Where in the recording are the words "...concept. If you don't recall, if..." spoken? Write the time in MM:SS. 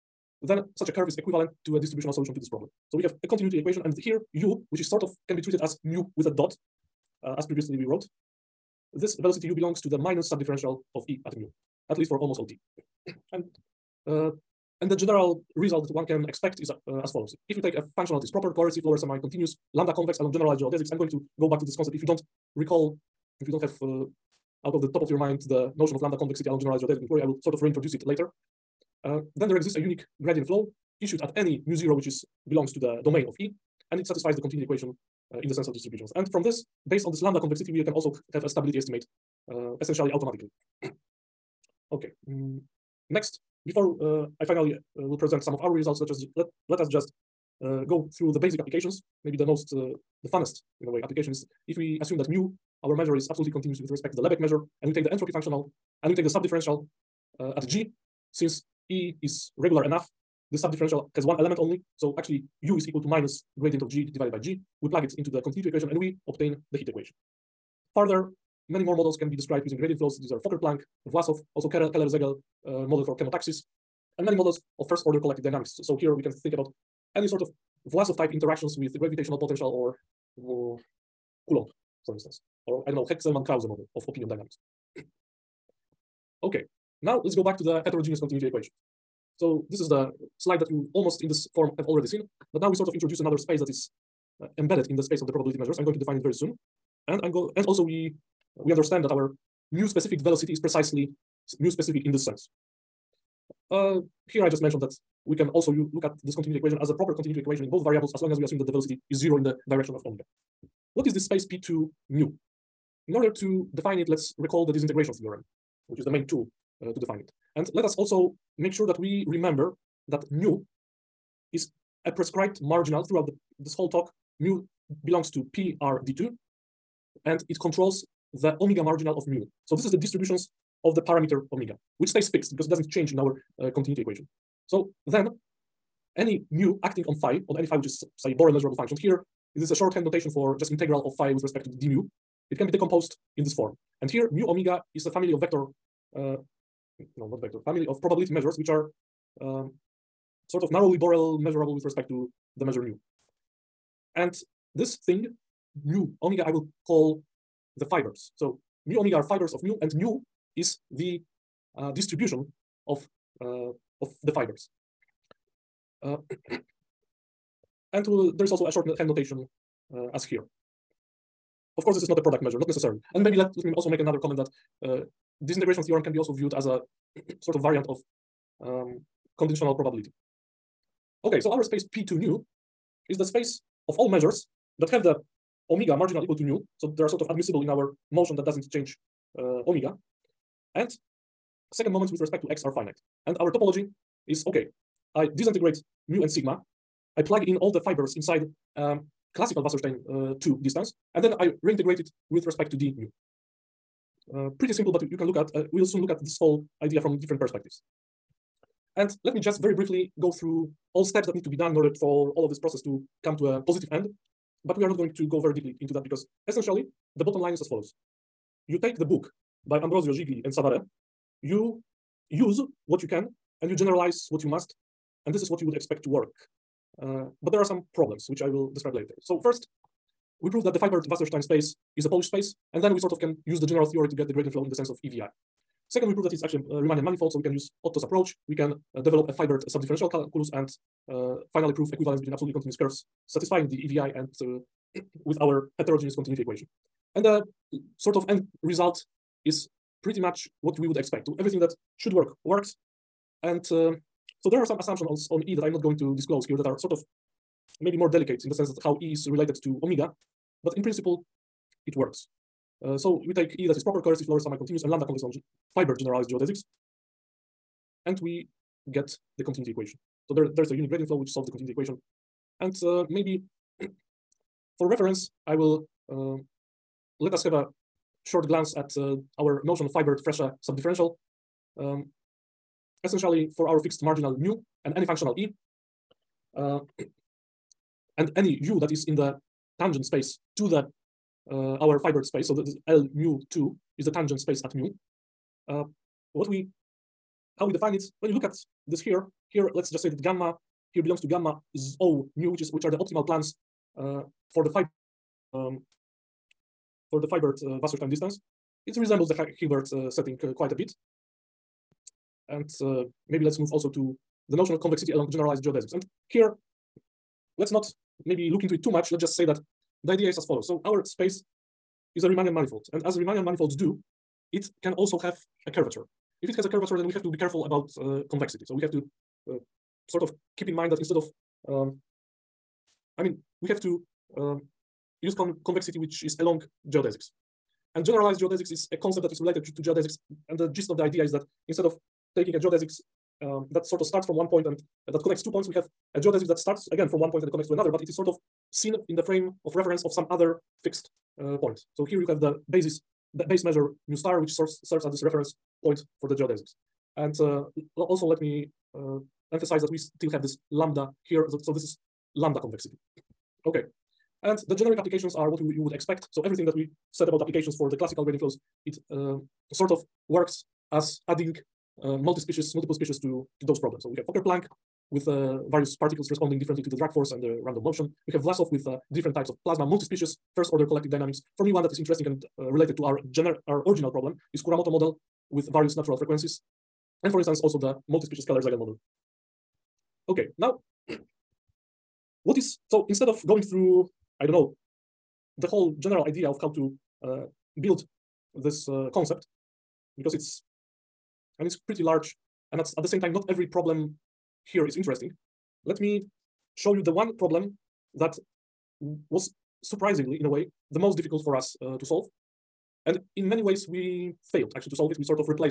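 00:21.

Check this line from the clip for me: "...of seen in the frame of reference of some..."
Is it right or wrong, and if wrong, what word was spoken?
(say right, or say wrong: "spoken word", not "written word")
right.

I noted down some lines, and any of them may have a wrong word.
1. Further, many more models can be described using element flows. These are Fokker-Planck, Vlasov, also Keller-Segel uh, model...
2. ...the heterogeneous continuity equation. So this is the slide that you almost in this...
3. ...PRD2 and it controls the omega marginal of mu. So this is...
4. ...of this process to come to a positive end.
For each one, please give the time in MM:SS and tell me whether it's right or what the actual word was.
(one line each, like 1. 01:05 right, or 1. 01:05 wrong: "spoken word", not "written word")
1. 01:07 wrong: "gradient", not "element"
2. 01:27 right
3. 02:05 right
4. 03:32 right.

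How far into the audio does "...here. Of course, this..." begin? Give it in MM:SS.
02:50.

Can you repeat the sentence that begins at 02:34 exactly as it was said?
And this thing, mu omega, I will call the fibers.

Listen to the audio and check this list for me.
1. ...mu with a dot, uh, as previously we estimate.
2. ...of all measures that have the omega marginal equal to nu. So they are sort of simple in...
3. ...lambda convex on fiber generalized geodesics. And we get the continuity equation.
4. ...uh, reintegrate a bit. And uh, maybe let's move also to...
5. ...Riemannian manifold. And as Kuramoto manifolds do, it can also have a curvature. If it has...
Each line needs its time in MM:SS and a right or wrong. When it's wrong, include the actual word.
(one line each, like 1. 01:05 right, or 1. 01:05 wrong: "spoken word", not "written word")
1. 00:05 wrong: "wrote", not "estimate"
2. 03:03 wrong: "admissible", not "simple"
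3. 04:24 right
4. 05:10 wrong: "quite", not "reintegrate"
5. 05:22 wrong: "Riemannian", not "Kuramoto".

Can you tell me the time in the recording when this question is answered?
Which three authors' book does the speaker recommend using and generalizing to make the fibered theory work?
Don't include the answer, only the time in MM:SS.
03:39.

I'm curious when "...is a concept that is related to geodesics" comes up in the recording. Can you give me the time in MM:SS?
05:38.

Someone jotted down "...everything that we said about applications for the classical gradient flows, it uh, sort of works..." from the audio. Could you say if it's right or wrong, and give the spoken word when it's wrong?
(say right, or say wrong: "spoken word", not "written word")
right.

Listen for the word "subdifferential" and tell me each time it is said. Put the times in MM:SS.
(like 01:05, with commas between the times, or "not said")
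00:10, 00:56, 01:00, 03:59, 04:40.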